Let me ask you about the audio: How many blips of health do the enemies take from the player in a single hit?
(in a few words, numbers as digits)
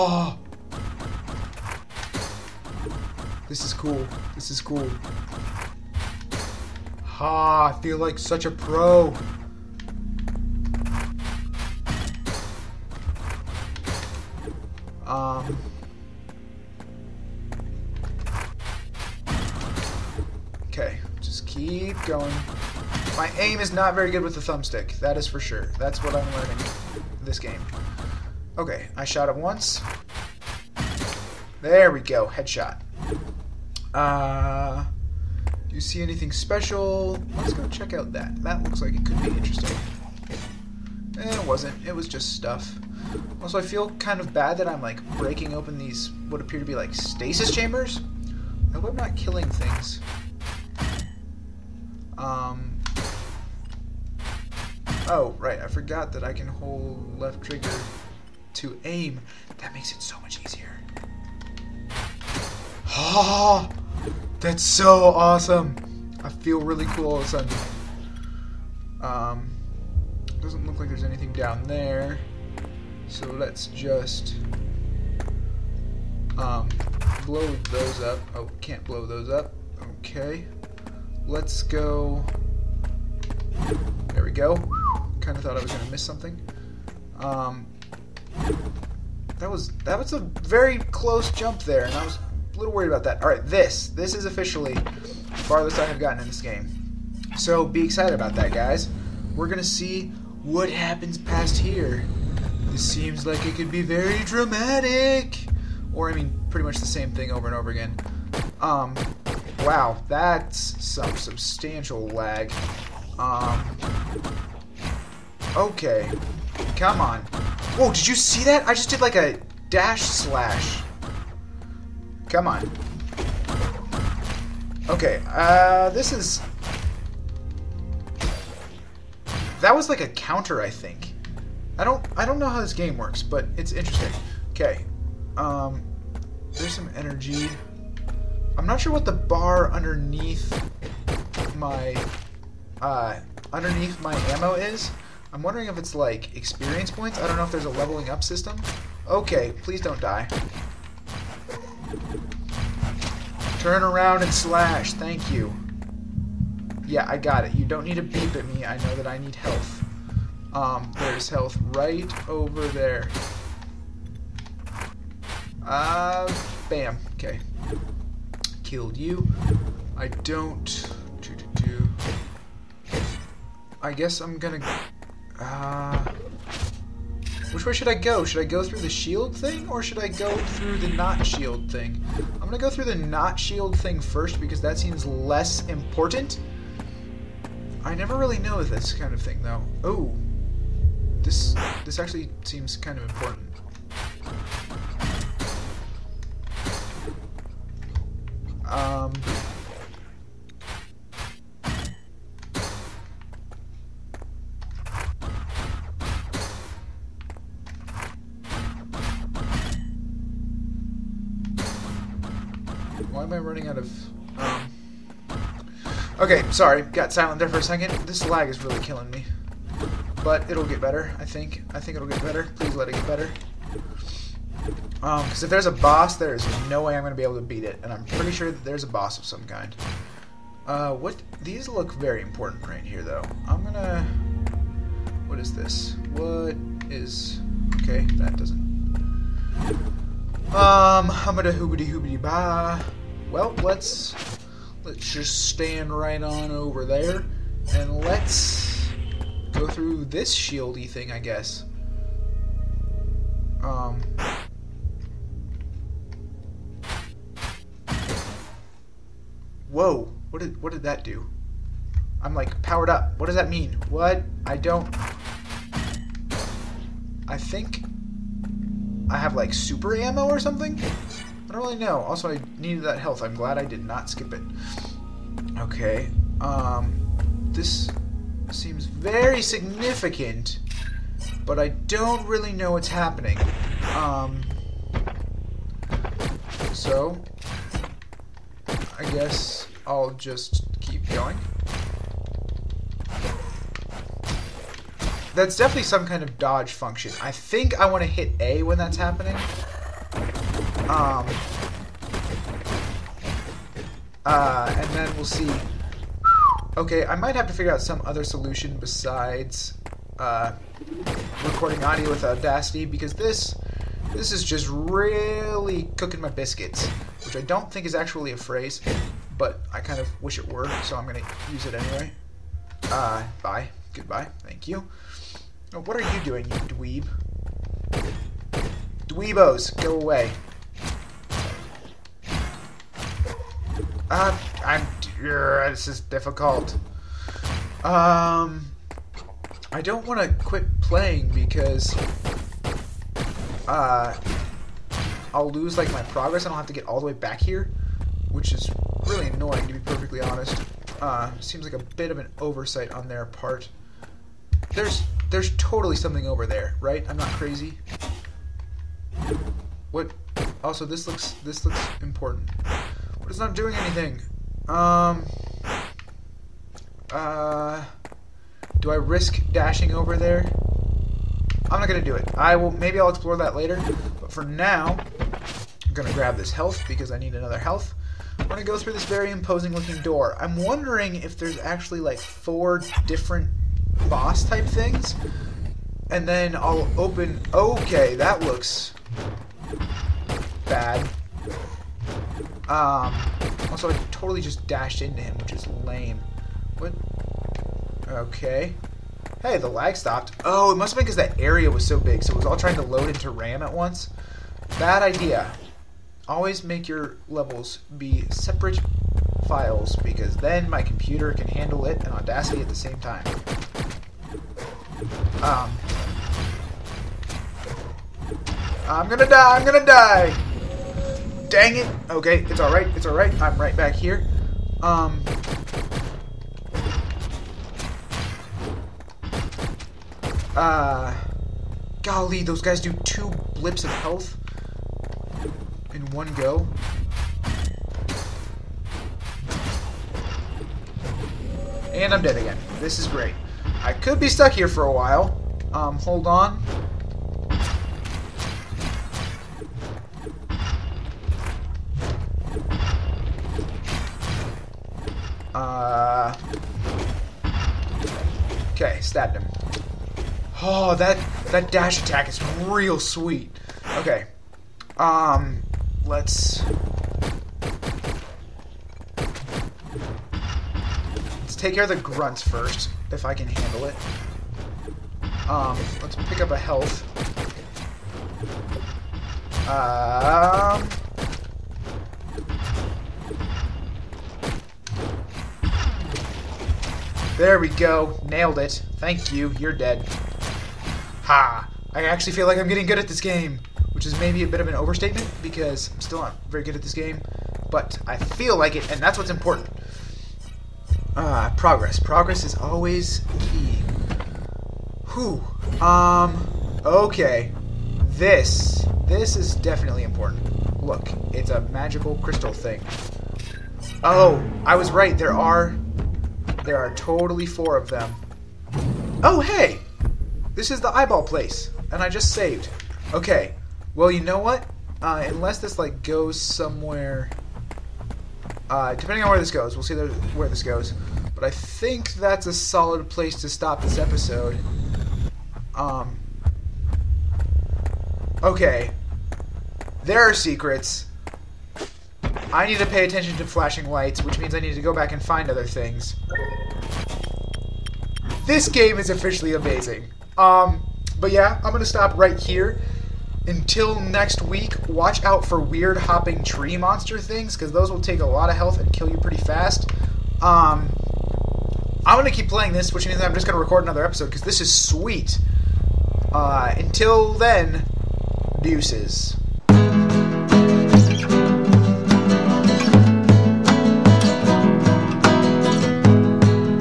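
2.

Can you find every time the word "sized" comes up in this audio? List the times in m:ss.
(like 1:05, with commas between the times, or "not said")
not said.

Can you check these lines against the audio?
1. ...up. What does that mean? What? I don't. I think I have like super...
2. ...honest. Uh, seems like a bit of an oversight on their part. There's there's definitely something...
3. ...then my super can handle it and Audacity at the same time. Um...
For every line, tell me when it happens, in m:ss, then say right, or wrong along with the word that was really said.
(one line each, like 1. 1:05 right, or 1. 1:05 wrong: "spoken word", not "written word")
1. 4:22 right
2. 5:50 wrong: "totally", not "definitely"
3. 6:50 wrong: "computer", not "super".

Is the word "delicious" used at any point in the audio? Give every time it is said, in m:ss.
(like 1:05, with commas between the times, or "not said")
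not said.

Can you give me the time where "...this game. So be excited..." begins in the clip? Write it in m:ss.
1:36.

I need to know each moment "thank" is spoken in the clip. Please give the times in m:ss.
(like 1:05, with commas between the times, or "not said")
2:34, 5:24, 8:08.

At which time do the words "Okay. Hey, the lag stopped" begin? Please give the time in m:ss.
6:38.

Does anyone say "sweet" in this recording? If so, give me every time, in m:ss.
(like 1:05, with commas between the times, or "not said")
7:42, 9:24.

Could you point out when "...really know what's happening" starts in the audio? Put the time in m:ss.
4:42.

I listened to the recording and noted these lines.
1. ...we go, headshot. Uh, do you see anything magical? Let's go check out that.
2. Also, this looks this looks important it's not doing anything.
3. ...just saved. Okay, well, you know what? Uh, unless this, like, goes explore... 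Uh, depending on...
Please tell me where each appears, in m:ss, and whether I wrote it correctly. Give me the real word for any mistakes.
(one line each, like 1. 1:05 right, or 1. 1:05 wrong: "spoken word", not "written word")
1. 0:31 wrong: "special", not "magical"
2. 6:00 right
3. 8:42 wrong: "somewhere", not "explore".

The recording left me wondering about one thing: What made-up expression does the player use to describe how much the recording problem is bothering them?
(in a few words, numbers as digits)
Cooking my biscuits.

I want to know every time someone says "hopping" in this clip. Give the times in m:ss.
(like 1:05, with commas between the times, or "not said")
9:15.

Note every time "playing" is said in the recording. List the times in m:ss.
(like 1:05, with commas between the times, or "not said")
5:40, 9:22.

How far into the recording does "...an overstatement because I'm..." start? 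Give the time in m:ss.
8:14.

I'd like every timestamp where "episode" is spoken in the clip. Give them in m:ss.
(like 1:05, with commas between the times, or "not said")
8:53, 9:24.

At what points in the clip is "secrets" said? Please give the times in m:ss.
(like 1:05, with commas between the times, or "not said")
9:00.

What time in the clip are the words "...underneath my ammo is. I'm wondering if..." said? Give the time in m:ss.
2:23.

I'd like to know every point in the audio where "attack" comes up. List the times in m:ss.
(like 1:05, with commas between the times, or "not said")
7:42.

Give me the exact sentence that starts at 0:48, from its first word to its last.
I hope I'm not killing things.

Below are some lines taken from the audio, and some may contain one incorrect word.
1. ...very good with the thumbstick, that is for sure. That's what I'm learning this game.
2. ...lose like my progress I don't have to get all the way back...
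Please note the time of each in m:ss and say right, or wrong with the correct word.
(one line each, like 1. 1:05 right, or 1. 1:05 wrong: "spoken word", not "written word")
1. 0:23 right
2. 5:45 right.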